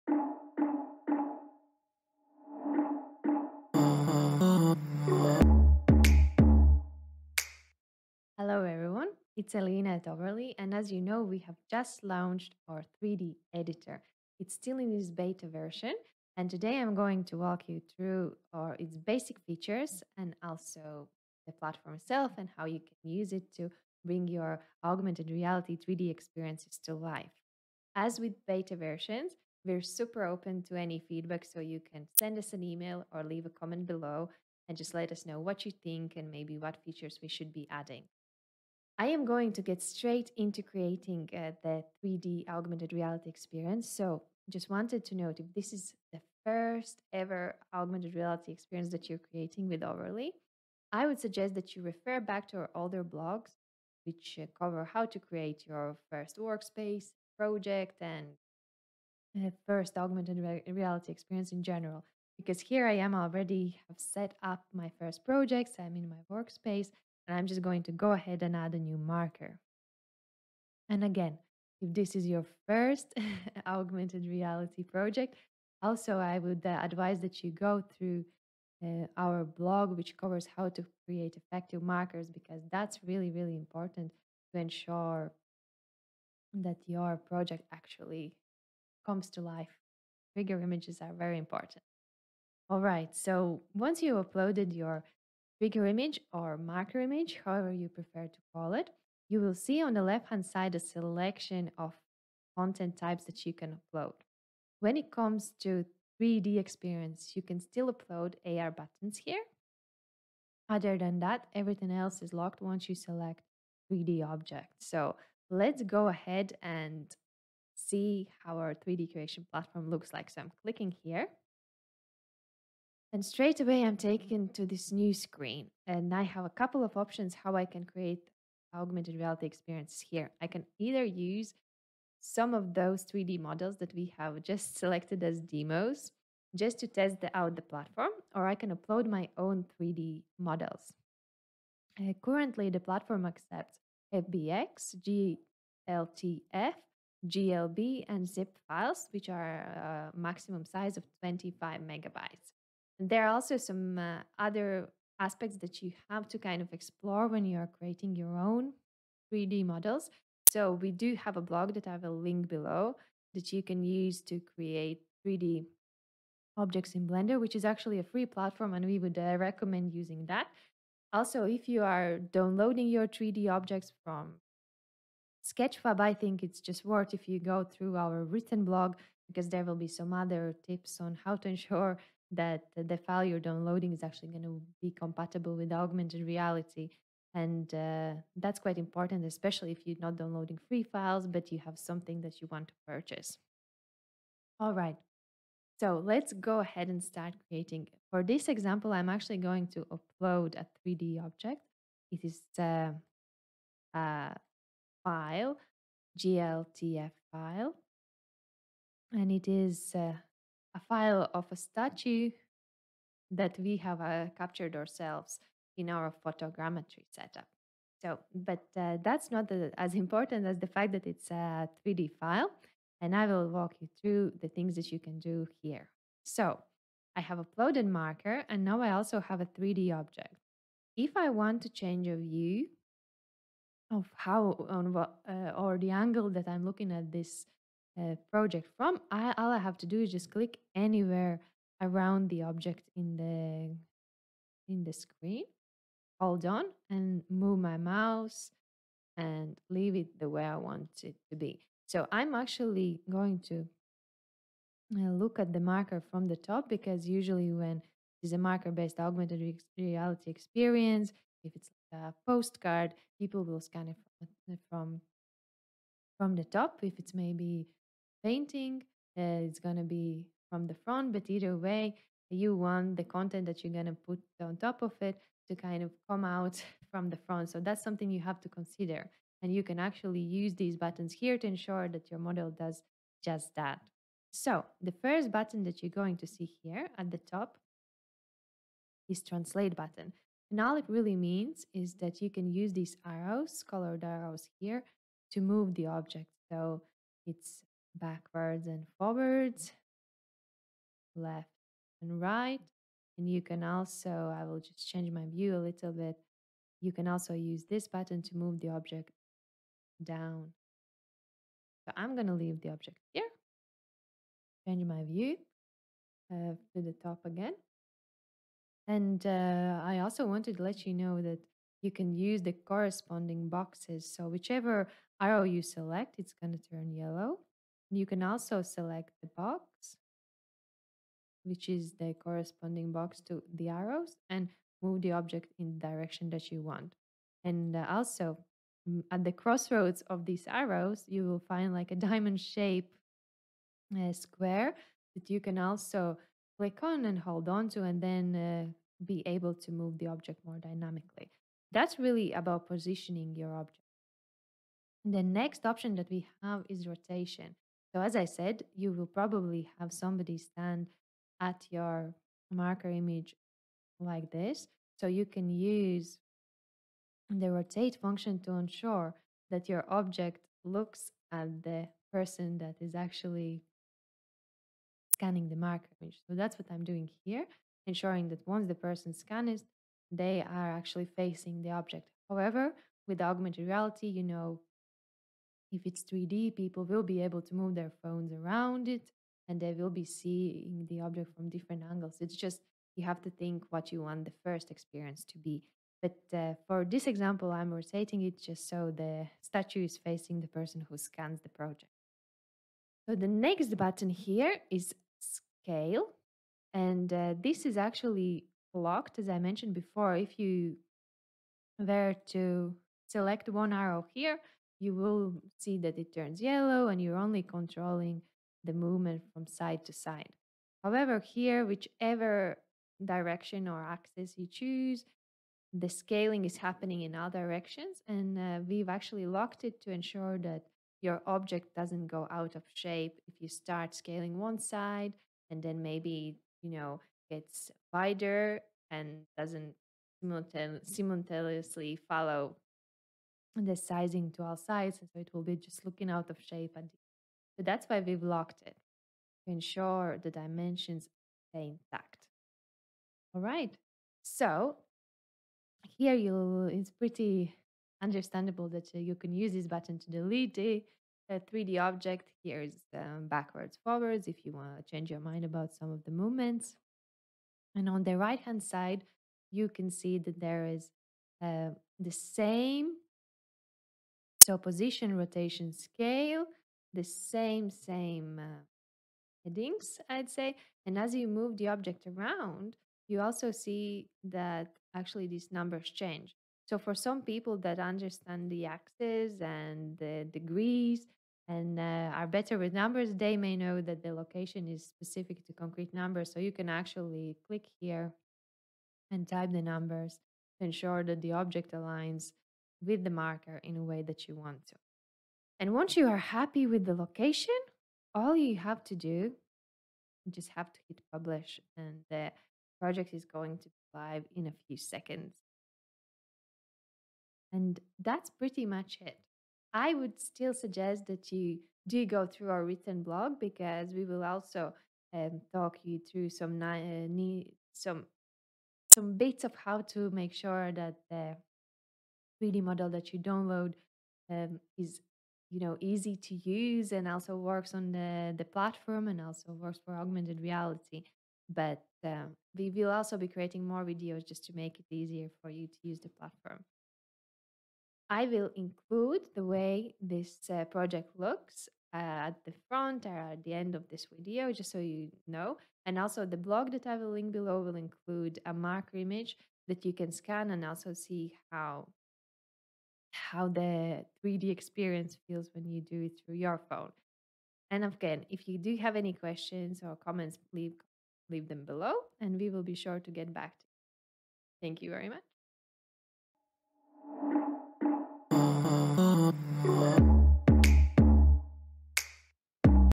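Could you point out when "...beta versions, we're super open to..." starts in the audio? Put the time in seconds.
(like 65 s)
28 s.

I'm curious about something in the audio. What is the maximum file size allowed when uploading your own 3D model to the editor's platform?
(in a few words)
25 megabytes.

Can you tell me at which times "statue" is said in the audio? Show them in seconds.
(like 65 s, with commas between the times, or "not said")
211 s, 399 s.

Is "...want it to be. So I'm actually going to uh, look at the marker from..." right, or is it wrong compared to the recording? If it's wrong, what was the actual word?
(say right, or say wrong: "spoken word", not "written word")
right.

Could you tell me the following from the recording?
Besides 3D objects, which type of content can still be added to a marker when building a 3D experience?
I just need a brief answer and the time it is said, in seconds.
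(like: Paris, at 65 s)
AR buttons, at 108 s.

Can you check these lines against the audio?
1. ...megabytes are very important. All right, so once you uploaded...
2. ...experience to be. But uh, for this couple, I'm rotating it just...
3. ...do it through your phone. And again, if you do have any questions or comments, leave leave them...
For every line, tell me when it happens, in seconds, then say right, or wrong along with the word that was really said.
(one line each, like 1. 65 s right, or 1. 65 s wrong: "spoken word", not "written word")
1. 90 s wrong: "images", not "megabytes"
2. 394 s wrong: "example", not "couple"
3. 565 s right.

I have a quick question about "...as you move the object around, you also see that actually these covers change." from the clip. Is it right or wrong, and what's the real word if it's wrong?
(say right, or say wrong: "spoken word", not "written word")
wrong: "numbers", not "covers".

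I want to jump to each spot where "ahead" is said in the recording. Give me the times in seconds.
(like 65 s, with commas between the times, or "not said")
68 s, 116 s, 196 s.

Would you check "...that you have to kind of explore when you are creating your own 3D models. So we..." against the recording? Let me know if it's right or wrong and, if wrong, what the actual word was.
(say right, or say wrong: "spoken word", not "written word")
right.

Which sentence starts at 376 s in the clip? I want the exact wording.
So, that's what I'm doing here, ensuring that once the person scans, they are actually facing the object.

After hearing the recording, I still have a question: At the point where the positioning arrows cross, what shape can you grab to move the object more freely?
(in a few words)
diamond shape.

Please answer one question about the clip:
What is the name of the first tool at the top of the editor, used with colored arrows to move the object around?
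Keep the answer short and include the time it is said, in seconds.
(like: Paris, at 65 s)
translate, at 289 s.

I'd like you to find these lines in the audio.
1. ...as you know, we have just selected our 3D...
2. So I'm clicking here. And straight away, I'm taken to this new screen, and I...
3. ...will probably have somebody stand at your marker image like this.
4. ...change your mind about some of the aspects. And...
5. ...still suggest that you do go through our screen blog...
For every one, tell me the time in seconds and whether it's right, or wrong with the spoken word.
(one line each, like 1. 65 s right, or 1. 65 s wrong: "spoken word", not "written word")
1. 10 s wrong: "launched", not "selected"
2. 120 s right
3. 358 s right
4. 464 s wrong: "movements", not "aspects"
5. 520 s wrong: "written", not "screen".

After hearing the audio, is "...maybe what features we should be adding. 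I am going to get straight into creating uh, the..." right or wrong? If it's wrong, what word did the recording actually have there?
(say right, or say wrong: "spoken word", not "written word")
right.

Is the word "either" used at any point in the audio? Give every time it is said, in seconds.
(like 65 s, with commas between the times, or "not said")
130 s, 271 s.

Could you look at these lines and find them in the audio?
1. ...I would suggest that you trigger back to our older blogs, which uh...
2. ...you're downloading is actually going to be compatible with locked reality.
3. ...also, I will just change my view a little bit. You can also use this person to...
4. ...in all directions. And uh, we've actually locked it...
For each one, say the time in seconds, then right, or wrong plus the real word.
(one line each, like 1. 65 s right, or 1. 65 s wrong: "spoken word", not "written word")
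1. 50 s wrong: "refer", not "trigger"
2. 183 s wrong: "augmented", not "locked"
3. 303 s wrong: "button", not "person"
4. 427 s right.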